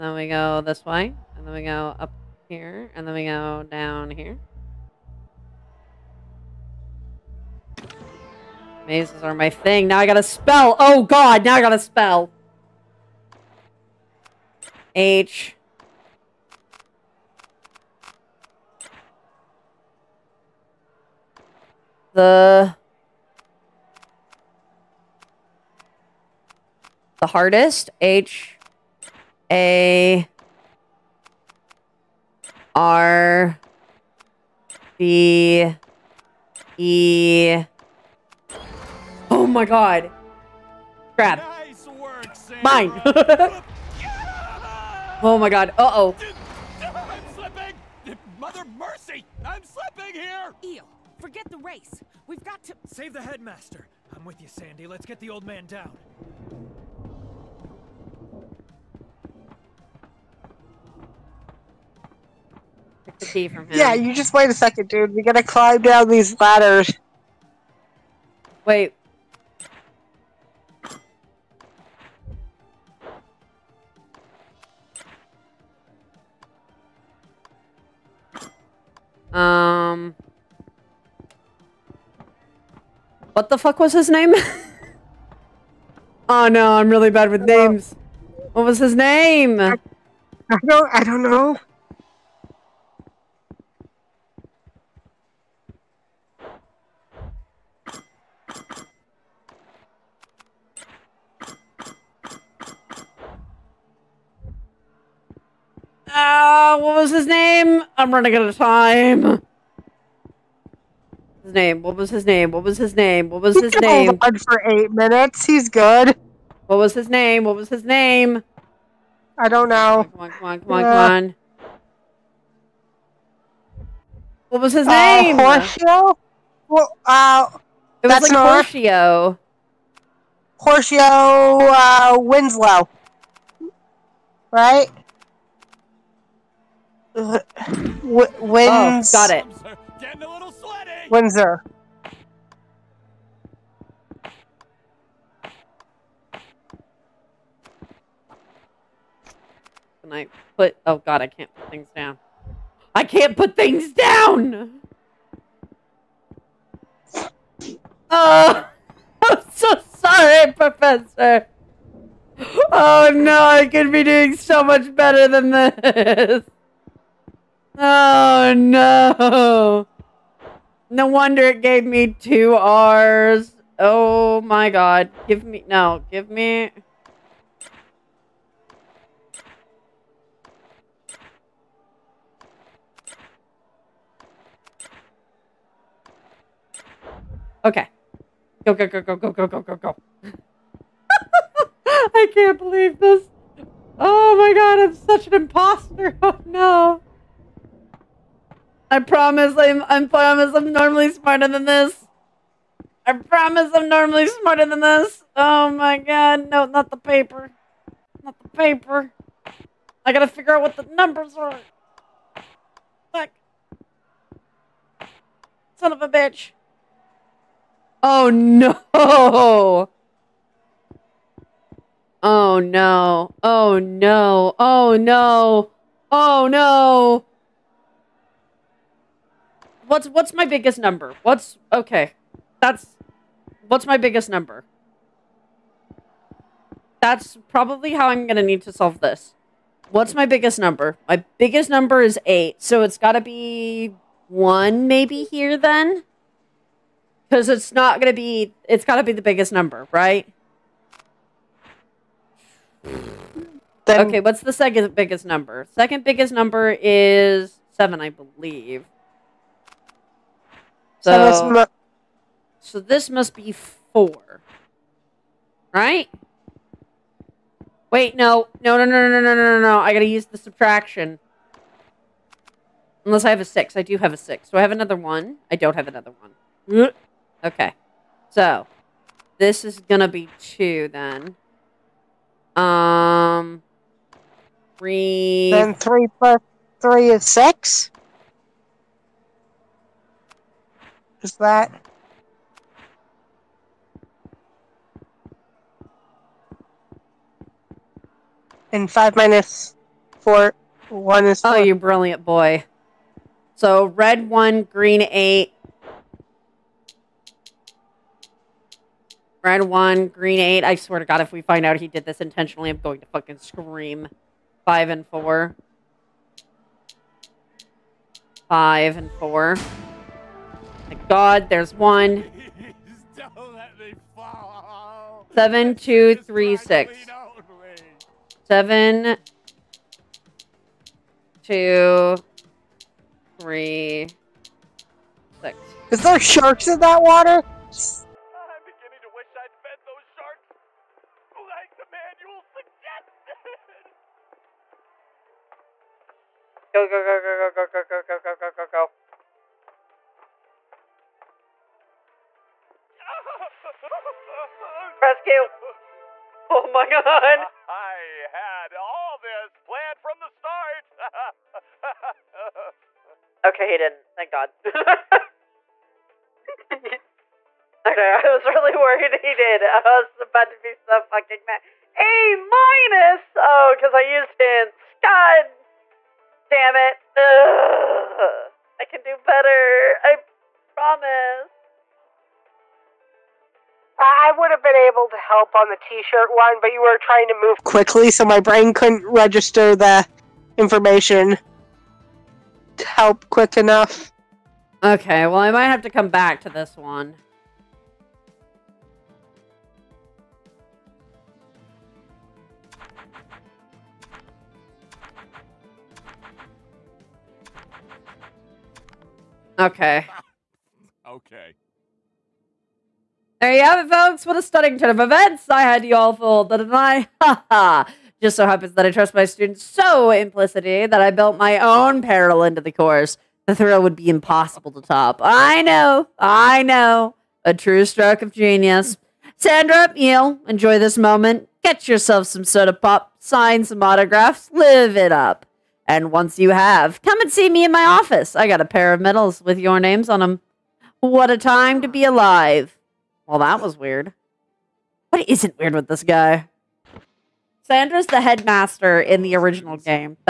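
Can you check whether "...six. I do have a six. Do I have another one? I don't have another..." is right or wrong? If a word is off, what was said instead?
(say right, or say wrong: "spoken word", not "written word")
right.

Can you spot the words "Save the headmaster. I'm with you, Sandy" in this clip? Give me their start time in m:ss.
0:52.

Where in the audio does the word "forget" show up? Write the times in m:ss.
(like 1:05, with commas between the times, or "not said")
0:51.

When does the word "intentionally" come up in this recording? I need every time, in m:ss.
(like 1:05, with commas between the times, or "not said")
5:12.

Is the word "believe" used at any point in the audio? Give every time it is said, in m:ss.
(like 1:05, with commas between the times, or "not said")
3:12, 4:18.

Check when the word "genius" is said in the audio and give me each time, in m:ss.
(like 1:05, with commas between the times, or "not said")
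7:08.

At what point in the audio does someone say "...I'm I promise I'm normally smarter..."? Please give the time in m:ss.
3:19.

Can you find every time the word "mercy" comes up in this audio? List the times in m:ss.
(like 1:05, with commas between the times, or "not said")
0:48.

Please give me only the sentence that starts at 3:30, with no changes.
I gotta figure out what the numbers are.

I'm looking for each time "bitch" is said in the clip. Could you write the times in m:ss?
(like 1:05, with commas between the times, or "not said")
3:36.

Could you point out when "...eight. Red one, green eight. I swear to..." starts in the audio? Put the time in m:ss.
5:05.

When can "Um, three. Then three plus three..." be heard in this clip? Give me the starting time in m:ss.
4:42.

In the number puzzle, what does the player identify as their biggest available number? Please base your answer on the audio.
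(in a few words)
8.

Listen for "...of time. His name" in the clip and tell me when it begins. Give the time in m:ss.
1:48.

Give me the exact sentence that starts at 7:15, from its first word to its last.
And once you have, come and see me in my office.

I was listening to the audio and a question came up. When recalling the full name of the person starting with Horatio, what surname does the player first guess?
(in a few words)
Winslow.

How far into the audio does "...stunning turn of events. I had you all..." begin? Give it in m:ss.
6:54.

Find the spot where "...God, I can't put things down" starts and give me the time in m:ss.
2:30.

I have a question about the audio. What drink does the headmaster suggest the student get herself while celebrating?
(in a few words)
Soda pop.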